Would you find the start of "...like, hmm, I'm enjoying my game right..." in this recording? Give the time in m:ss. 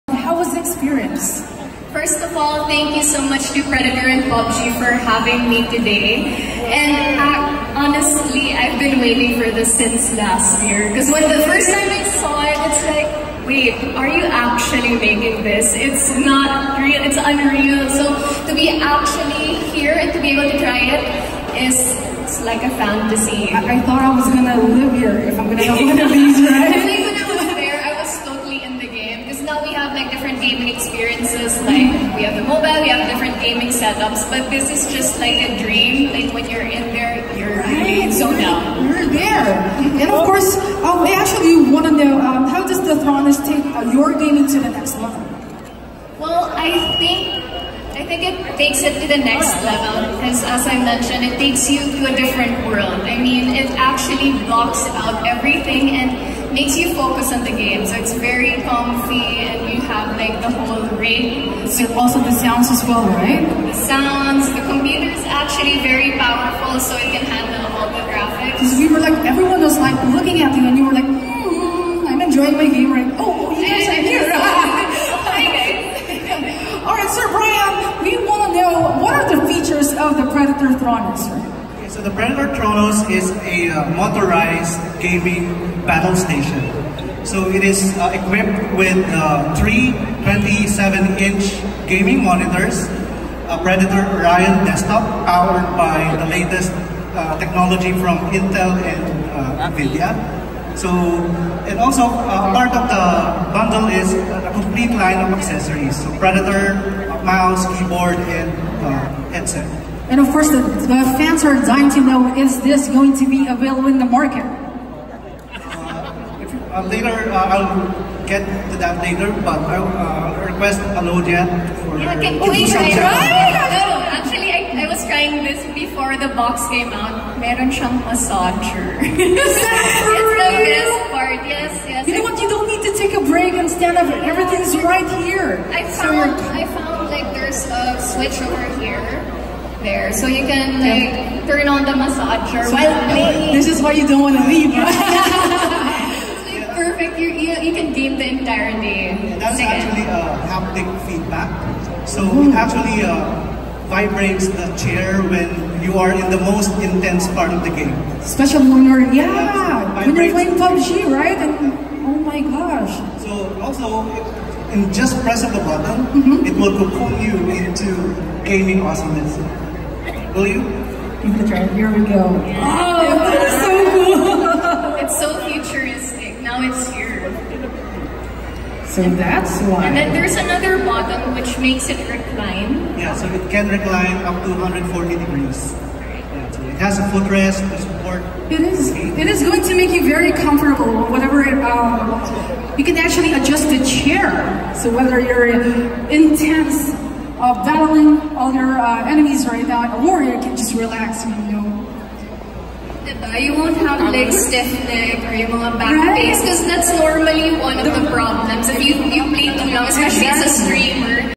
1:10.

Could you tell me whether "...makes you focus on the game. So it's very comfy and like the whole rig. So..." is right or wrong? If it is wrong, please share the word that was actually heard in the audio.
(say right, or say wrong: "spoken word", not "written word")
right.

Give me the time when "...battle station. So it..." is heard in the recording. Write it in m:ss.
1:25.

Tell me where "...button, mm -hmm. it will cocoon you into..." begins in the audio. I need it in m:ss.
2:45.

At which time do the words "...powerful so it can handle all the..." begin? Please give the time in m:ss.
1:06.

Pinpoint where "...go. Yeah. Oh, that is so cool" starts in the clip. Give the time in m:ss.
2:52.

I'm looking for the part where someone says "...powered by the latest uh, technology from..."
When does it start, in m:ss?
1:35.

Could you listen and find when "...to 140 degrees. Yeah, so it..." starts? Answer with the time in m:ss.
3:04.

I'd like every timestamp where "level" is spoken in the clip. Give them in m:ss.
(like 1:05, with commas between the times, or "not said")
0:44, 0:49.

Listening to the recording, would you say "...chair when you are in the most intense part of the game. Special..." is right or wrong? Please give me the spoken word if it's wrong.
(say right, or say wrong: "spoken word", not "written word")
right.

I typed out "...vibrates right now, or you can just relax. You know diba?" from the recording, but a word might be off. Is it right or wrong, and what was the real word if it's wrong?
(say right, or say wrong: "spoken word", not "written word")
wrong: "enemies", not "vibrates".